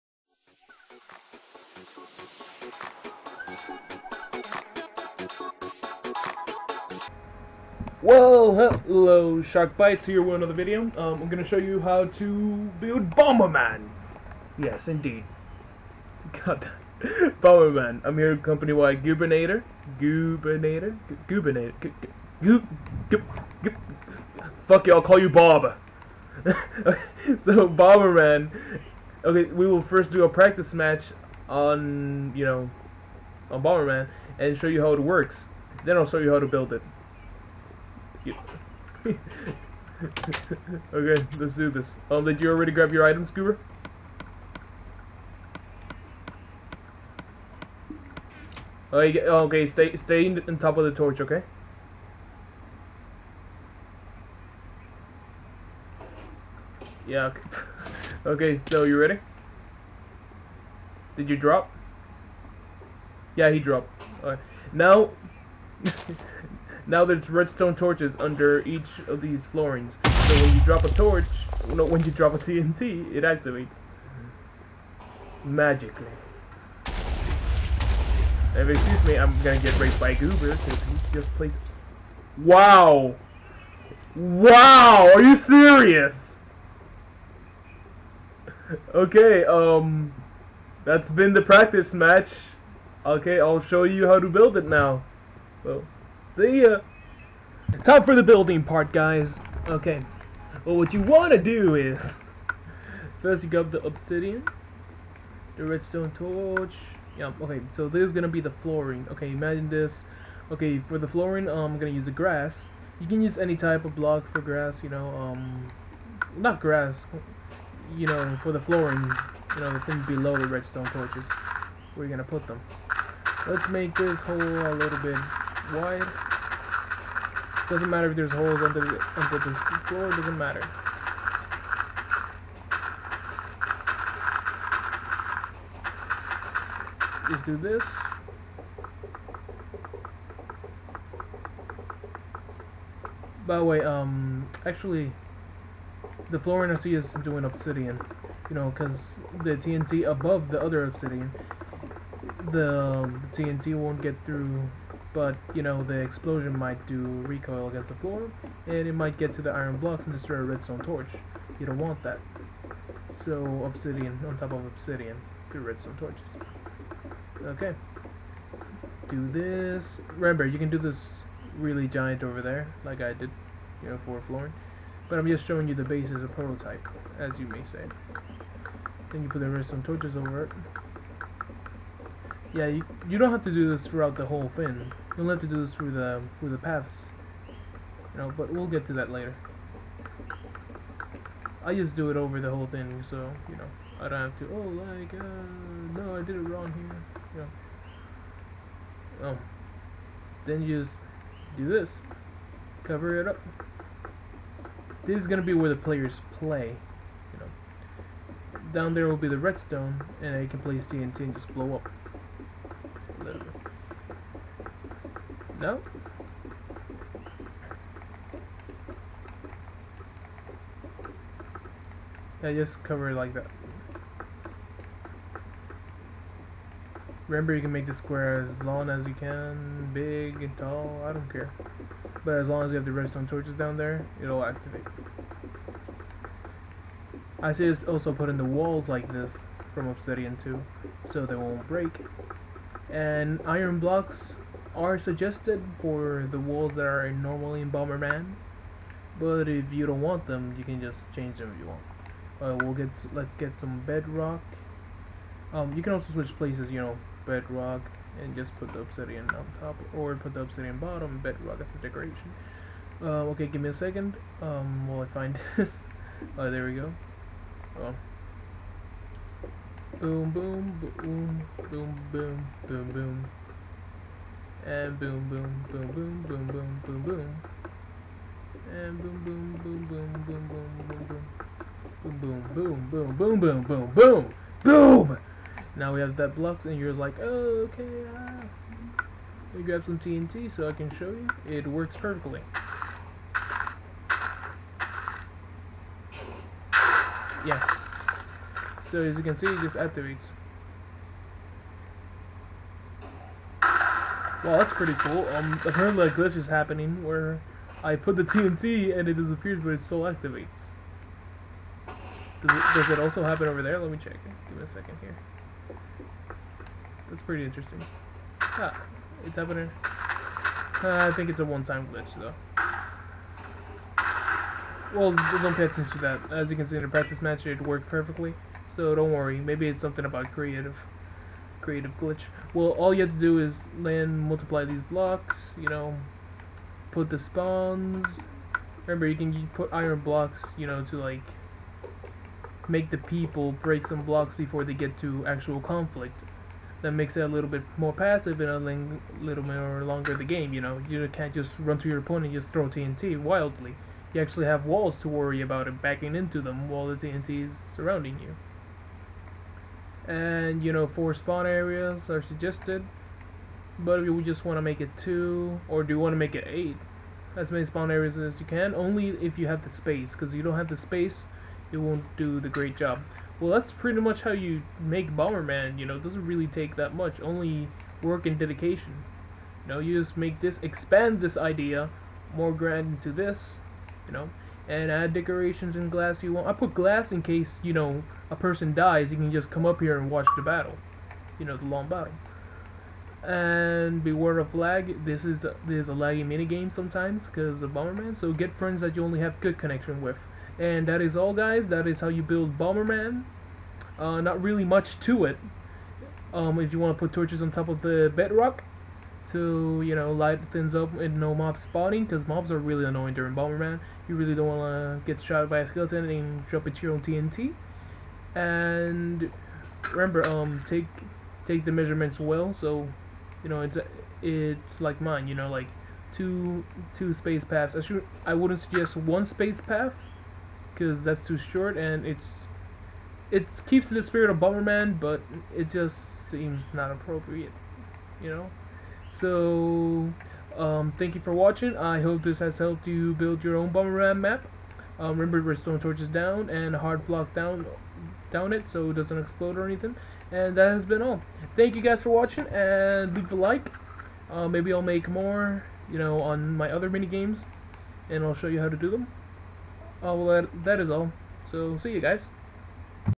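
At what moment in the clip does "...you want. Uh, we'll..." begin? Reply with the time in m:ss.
4:11.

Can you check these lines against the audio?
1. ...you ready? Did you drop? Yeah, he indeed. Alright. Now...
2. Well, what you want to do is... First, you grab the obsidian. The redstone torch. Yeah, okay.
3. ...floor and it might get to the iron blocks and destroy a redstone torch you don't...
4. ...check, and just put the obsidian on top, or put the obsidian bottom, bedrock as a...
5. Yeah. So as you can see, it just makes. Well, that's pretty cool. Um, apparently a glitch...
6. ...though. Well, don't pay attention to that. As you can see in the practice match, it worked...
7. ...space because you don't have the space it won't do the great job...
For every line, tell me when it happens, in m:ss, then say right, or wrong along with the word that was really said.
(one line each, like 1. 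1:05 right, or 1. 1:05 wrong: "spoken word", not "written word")
1. 0:58 wrong: "dropped", not "indeed"
2. 1:40 right
3. 2:37 right
4. 4:17 wrong: "bedrock", not "check"
5. 4:57 wrong: "activates", not "makes"
6. 5:22 right
7. 6:09 right.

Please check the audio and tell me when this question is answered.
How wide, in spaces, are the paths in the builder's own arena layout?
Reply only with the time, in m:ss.
7:06.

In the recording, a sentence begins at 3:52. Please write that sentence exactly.
But as long as you have the redstone torches down there, it'll activate.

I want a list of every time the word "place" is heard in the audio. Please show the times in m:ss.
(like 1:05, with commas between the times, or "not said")
3:30, 4:16.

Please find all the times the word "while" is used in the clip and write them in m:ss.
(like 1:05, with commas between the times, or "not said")
4:24, 5:56.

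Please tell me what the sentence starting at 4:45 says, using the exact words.
Now we have that blocked, and you're like, oh, okay, Let me grab some TNT so I can show you.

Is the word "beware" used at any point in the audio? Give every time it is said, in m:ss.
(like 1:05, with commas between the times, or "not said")
6:34.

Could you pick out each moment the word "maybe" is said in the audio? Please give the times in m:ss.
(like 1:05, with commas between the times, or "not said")
5:29, 7:34.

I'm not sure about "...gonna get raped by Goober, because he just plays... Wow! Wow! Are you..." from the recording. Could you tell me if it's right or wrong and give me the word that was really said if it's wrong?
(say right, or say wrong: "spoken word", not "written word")
right.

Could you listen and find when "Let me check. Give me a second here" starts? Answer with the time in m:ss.
5:13.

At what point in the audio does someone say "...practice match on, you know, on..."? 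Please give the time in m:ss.
0:30.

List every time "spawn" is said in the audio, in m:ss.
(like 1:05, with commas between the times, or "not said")
5:37, 6:01, 6:07.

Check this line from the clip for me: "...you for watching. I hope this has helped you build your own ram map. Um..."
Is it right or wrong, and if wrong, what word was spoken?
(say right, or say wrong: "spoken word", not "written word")
right.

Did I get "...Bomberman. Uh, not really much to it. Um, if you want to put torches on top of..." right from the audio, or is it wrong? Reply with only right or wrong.
right.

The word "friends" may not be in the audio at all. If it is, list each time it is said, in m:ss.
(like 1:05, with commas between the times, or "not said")
6:38.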